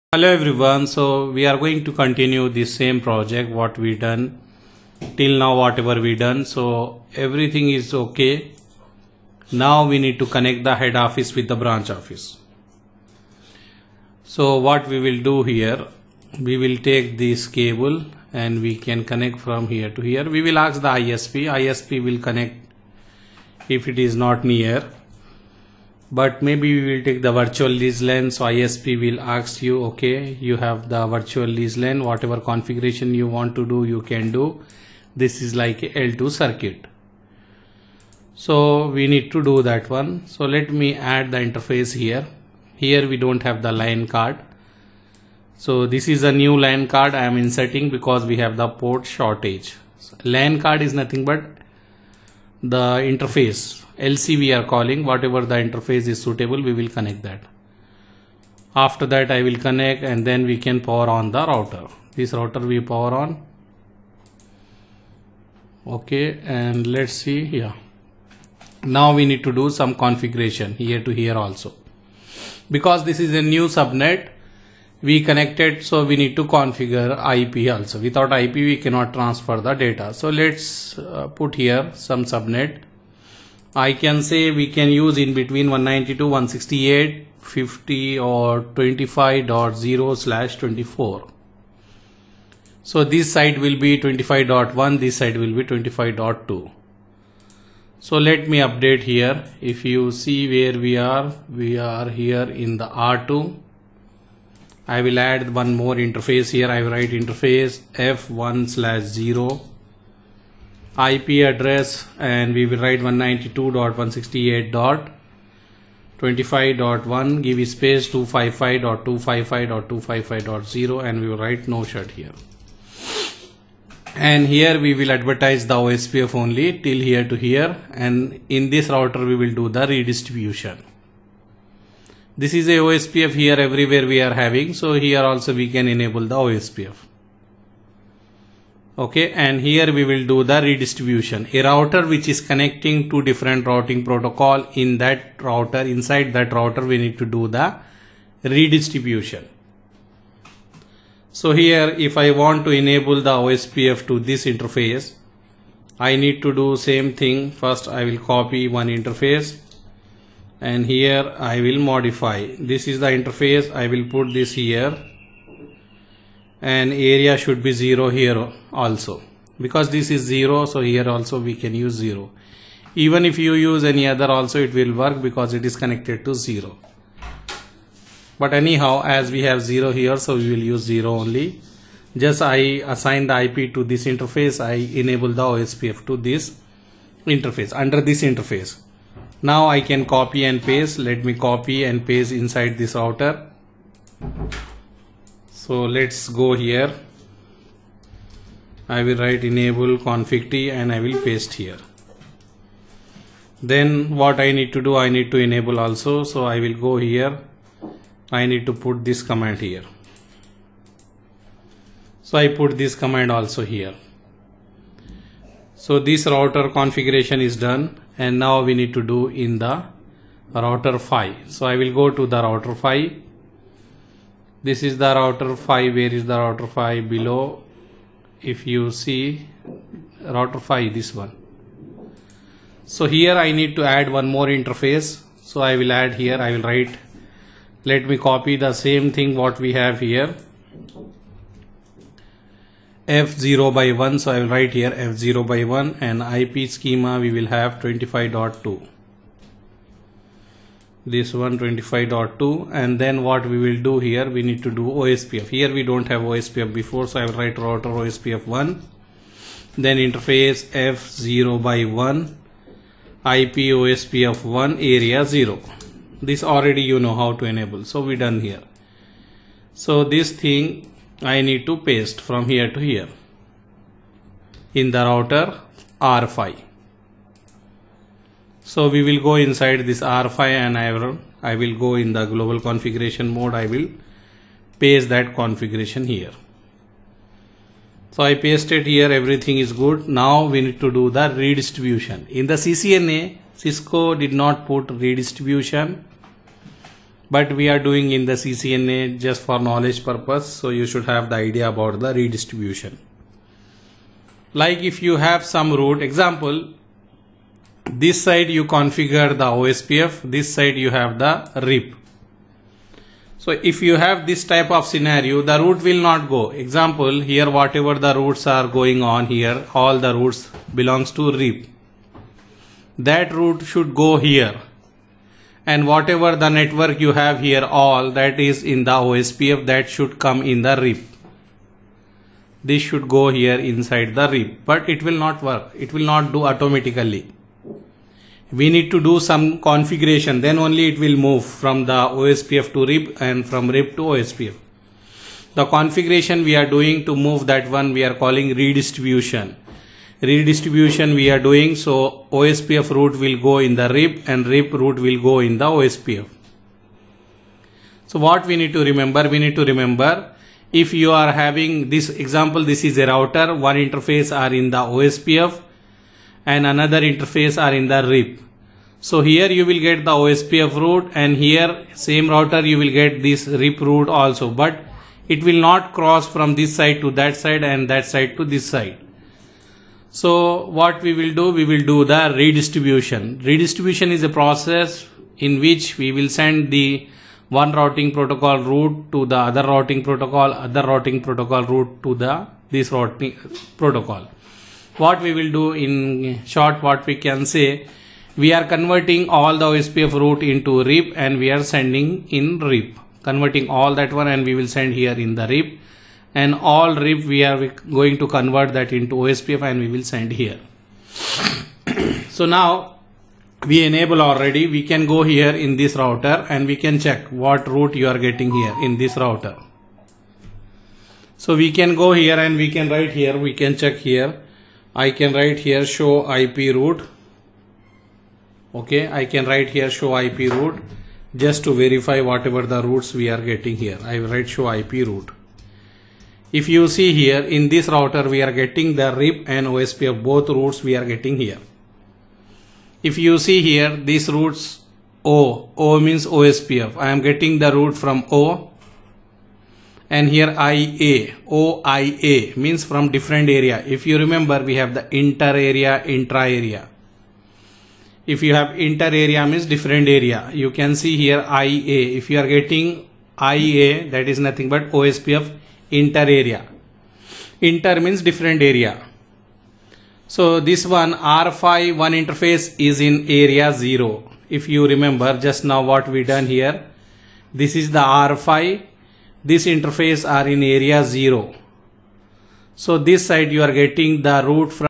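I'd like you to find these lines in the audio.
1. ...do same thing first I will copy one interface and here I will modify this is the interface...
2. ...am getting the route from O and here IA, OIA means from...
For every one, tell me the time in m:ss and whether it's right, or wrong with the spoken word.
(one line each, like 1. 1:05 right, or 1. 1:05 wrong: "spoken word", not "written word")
1. 2:36 right
2. 7:27 right.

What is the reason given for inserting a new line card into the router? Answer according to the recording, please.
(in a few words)
port shortage.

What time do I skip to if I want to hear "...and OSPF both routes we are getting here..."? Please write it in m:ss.
7:19.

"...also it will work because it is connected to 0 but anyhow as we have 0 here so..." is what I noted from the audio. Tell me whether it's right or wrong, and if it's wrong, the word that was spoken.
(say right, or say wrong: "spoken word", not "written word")
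right.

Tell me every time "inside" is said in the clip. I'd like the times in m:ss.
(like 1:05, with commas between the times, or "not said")
2:25, 3:12, 4:39, 5:33.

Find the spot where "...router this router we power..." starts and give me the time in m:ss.
1:01.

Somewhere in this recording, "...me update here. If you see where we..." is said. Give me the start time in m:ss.
1:38.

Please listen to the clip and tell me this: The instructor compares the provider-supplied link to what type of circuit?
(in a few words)
L2 circuit.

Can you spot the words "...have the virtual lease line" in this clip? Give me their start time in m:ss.
0:30.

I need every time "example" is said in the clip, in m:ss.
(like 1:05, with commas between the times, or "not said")
5:06, 5:16, 6:02.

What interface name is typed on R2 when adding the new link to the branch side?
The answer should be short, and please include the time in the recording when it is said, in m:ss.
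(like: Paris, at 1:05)
F1/0, at 1:47.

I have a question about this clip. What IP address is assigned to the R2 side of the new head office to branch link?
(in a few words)
192.168.25.1.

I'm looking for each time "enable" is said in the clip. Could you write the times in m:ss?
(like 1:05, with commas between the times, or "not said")
2:15, 2:32, 3:04, 3:19, 3:25, 4:27, 6:53.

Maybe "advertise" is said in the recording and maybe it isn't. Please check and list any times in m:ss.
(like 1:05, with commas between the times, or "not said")
2:05.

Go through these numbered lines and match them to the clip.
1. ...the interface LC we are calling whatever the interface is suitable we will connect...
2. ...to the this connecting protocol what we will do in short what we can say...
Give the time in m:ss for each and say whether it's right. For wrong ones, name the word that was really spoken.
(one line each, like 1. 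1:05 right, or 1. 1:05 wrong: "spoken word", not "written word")
1. 0:52 right
2. 6:32 wrong: "routing", not "connecting".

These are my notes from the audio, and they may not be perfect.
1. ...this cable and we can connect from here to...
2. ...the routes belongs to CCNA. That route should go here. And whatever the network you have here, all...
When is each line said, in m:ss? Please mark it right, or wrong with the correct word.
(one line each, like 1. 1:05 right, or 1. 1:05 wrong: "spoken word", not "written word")
1. 0:17 right
2. 5:19 wrong: "RIP", not "CCNA".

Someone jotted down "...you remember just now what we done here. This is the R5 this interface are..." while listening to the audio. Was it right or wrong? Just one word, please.
right.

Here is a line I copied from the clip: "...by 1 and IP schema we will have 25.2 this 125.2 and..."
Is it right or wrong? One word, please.
right.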